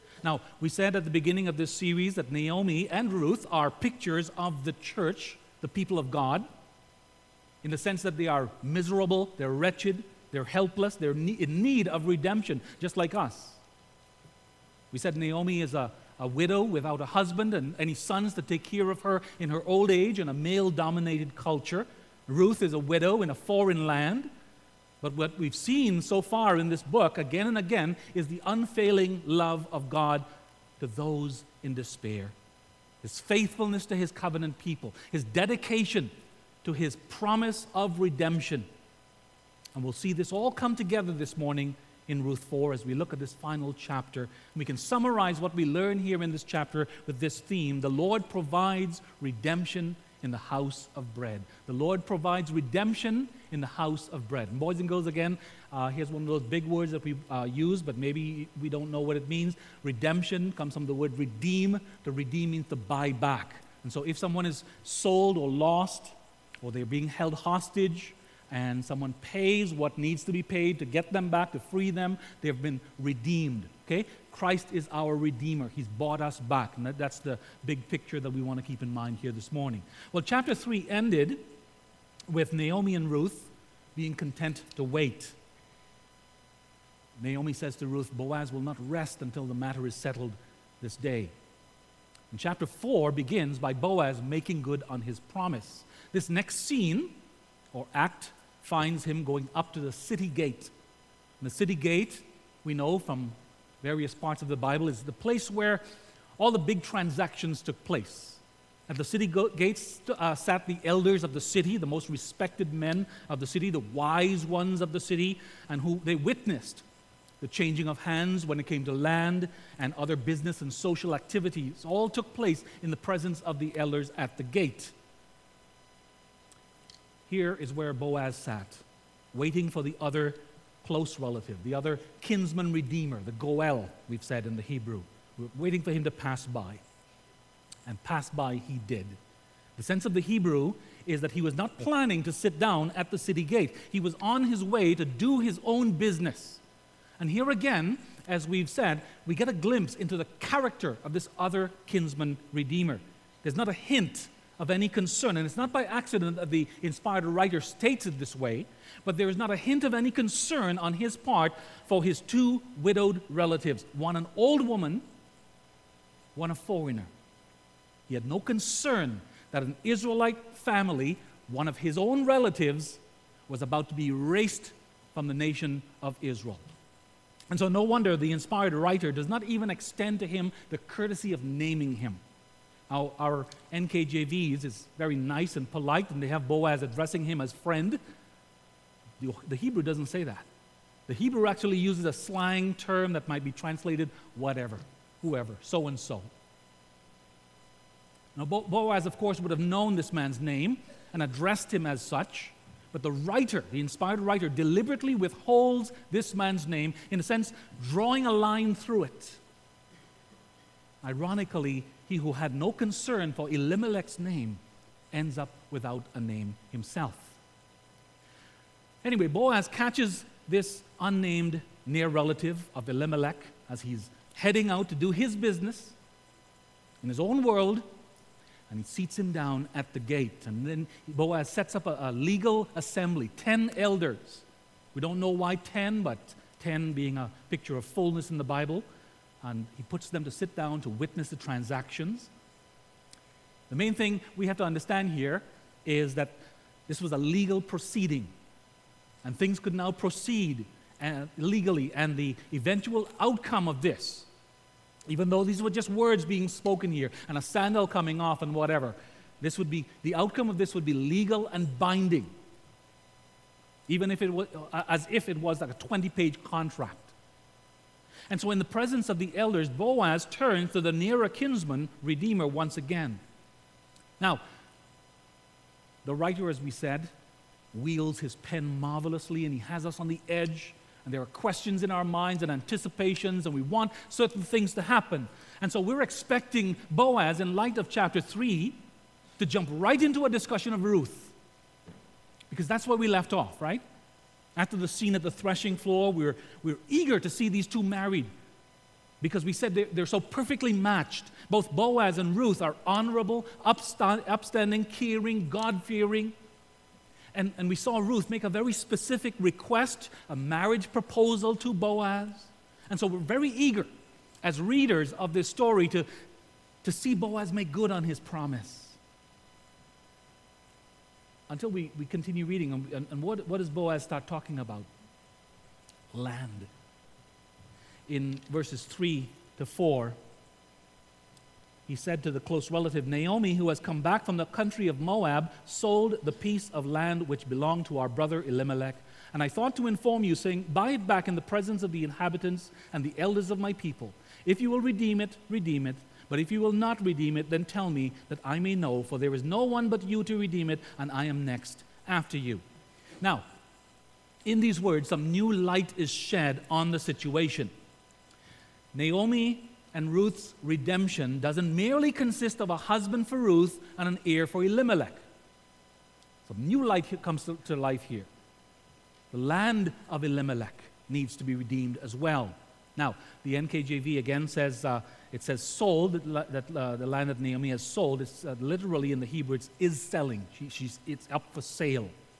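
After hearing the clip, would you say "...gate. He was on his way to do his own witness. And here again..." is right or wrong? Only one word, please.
wrong.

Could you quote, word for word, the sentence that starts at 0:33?
His faithfulness to his covenant people, his dedication to his promise of redemption.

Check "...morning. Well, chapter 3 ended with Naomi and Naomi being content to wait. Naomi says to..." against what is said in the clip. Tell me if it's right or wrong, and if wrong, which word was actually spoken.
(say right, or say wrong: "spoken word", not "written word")
wrong: "Ruth", not "Naomi".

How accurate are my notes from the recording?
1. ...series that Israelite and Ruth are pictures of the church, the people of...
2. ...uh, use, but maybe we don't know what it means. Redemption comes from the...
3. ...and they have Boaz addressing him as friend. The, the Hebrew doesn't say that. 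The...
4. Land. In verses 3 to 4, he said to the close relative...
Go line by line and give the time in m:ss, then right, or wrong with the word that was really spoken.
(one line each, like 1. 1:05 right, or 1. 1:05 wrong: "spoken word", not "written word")
1. 0:01 wrong: "Naomi", not "Israelite"
2. 0:57 right
3. 3:06 right
4. 5:26 right.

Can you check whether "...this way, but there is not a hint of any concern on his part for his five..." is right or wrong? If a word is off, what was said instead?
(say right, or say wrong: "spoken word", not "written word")
wrong: "two", not "five".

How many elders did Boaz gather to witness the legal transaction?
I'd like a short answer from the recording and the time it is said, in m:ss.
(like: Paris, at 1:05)
10, at 3:53.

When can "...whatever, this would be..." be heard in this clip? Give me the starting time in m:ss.
4:18.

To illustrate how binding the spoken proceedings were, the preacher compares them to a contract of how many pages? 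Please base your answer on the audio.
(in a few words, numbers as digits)
20.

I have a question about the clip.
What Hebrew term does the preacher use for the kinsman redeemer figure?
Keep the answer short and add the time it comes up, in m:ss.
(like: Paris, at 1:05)
Goel, at 2:13.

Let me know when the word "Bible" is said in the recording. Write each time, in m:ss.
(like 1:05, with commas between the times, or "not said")
1:44, 3:58.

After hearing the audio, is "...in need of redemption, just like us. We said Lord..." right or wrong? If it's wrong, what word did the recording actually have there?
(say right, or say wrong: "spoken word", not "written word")
wrong: "Naomi", not "Lord".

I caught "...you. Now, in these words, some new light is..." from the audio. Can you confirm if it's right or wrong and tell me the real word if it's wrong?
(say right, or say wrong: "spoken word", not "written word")
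right.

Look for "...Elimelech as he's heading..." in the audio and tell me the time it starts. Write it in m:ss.
3:42.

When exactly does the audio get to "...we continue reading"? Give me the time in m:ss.
5:21.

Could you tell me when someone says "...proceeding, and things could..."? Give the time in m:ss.
4:07.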